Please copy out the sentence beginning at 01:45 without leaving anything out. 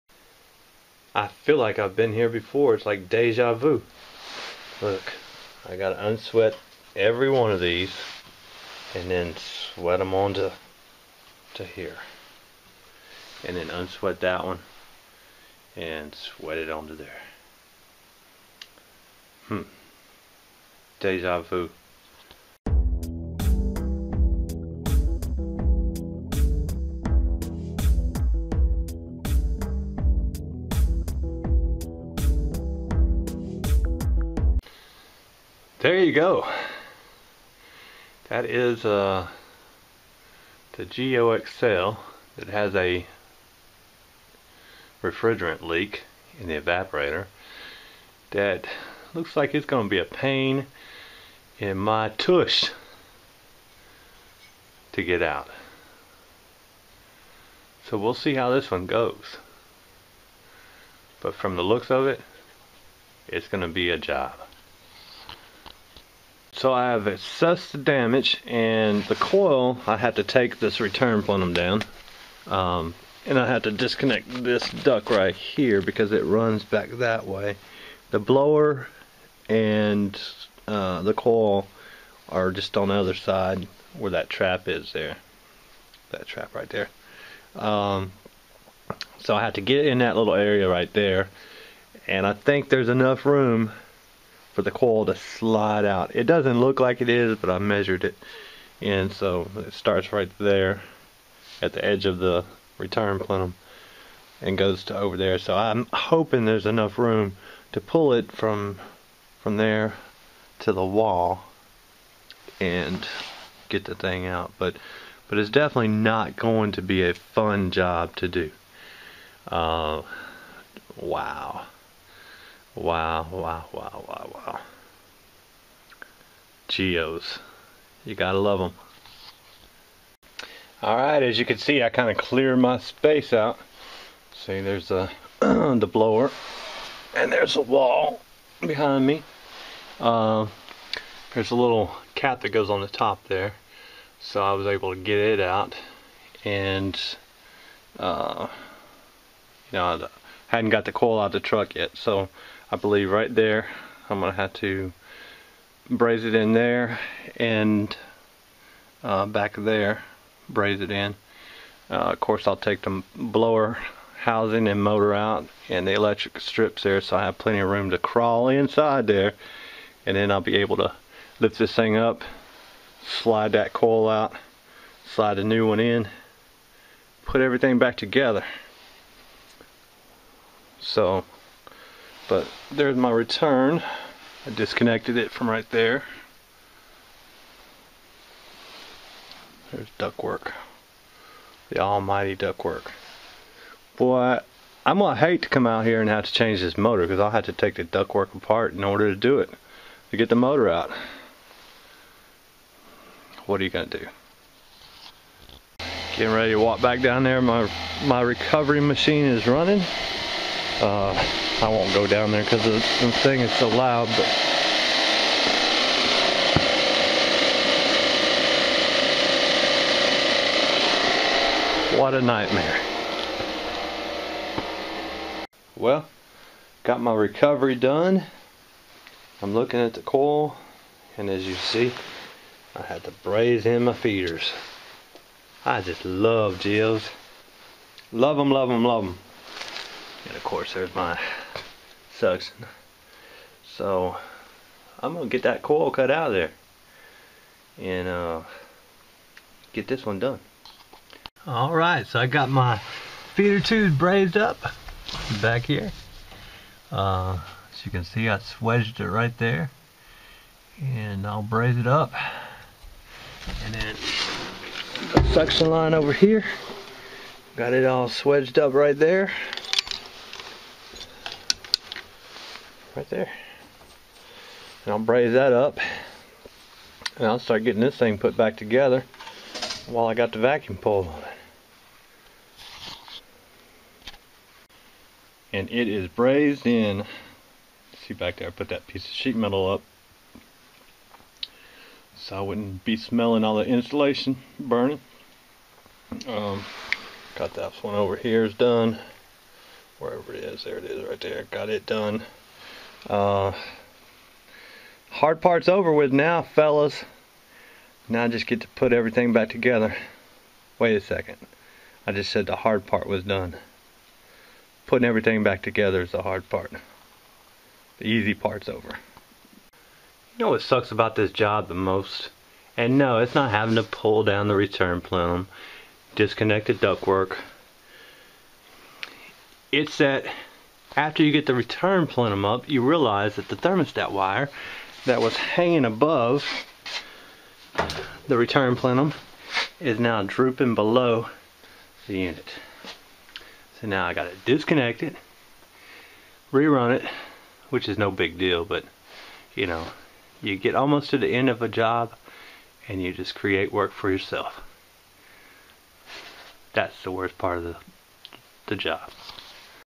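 So I'm hoping there's enough room to pull it from from there to the wall and get the thing out.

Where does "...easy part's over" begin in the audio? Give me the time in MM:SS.
05:18.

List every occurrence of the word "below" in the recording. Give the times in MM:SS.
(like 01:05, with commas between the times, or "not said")
05:40.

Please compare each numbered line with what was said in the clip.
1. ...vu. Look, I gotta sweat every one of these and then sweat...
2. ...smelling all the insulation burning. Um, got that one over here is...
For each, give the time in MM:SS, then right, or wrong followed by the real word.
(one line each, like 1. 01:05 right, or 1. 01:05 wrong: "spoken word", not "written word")
1. 00:03 wrong: "unsweat", not "sweat"
2. 04:52 right.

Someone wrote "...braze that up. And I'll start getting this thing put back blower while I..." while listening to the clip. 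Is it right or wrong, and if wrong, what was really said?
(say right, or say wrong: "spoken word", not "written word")
wrong: "together", not "blower".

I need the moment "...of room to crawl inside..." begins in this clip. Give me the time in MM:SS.
02:47.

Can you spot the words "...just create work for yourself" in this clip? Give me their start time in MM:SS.
05:53.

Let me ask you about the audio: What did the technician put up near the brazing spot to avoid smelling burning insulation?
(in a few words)
sheet metal.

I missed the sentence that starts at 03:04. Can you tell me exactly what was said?
I disconnected it from right there.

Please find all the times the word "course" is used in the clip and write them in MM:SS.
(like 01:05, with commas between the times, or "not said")
02:42, 04:00.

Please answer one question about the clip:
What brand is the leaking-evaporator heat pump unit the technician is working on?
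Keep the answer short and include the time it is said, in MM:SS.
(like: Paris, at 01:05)
Geo Excel, at 00:40.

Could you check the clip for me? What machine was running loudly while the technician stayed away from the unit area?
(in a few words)
recovery machine.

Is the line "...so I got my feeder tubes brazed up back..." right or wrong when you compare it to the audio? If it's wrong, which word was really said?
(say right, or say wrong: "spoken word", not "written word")
right.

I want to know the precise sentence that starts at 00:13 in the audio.
And then unsweat that one and sweat it onto there.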